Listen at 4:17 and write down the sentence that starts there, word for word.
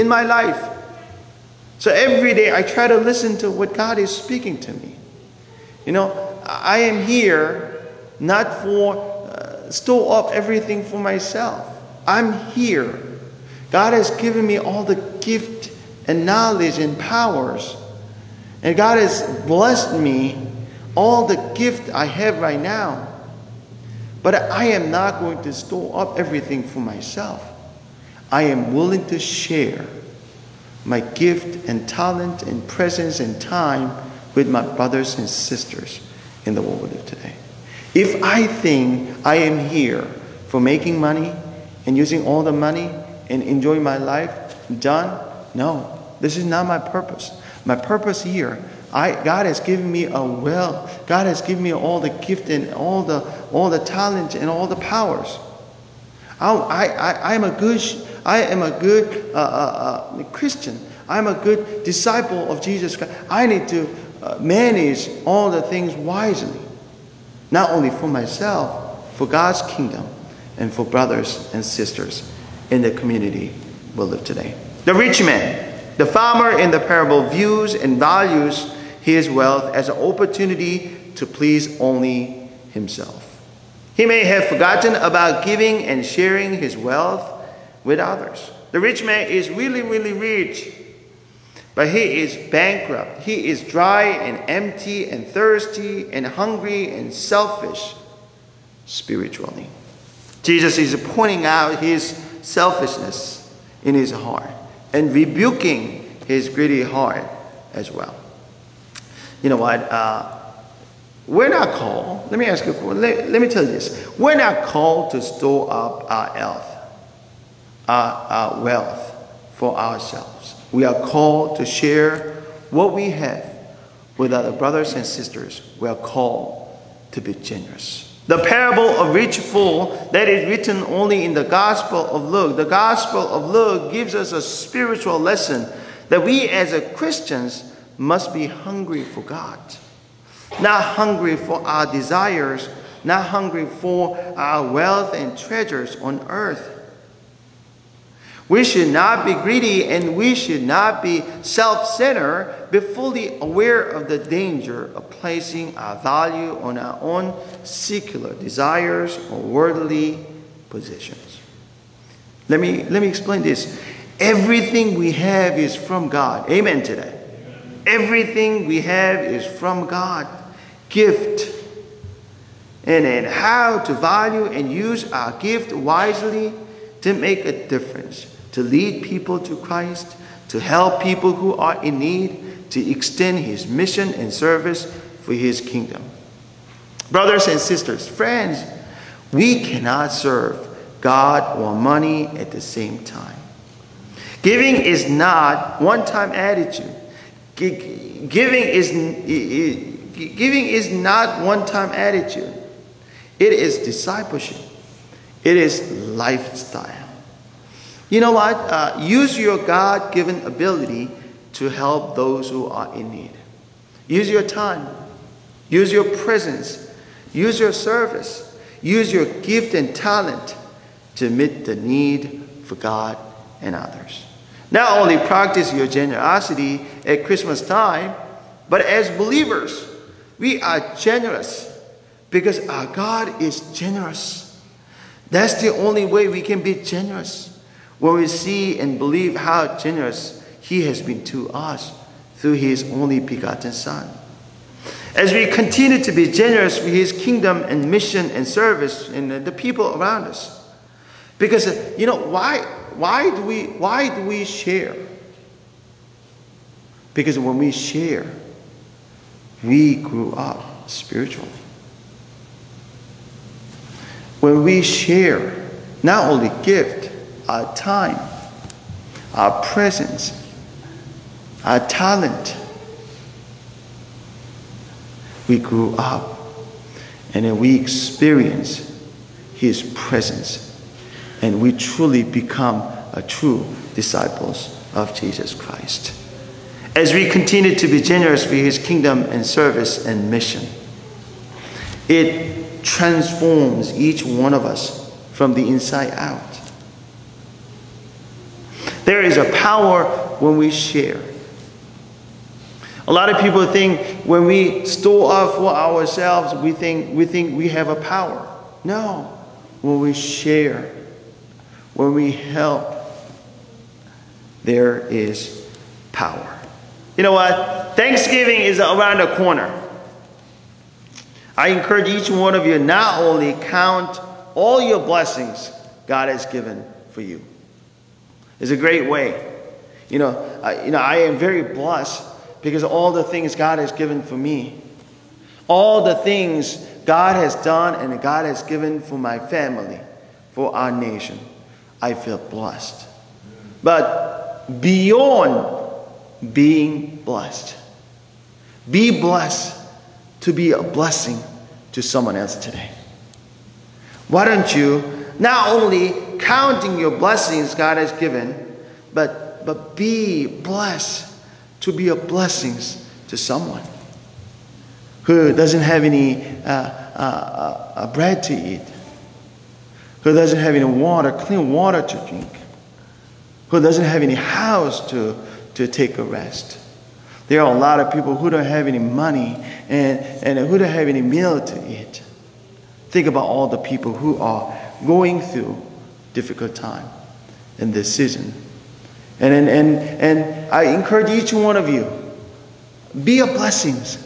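Because when we share, we grew up spiritually.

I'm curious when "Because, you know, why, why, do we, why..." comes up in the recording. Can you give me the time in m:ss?
4:11.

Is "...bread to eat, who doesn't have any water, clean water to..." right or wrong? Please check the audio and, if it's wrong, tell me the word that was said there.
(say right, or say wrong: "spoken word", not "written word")
right.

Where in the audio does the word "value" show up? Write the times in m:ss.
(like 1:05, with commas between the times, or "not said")
1:17, 2:35, 2:53.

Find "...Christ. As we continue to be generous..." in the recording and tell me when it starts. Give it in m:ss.
4:45.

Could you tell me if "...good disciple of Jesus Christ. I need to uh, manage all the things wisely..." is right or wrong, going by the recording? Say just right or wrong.
right.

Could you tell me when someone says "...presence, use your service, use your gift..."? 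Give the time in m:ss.
3:36.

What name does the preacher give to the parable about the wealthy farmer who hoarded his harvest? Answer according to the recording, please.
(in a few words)
parable of rich fool.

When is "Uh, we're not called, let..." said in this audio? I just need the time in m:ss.
1:49.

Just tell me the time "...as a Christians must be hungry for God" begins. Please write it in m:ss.
2:16.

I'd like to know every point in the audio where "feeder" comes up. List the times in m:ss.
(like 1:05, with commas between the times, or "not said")
not said.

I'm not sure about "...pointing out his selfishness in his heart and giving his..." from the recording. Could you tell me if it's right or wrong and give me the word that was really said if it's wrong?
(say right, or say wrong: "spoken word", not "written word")
wrong: "rebuking", not "giving".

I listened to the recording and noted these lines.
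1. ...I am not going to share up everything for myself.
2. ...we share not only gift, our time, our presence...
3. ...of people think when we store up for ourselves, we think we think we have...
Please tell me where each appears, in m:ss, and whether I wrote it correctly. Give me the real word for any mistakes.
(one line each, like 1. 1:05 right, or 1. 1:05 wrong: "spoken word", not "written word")
1. 0:24 wrong: "store", not "share"
2. 4:24 right
3. 5:03 right.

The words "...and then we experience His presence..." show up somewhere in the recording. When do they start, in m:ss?
4:37.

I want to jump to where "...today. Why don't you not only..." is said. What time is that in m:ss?
5:52.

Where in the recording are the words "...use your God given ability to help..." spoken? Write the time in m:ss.
3:29.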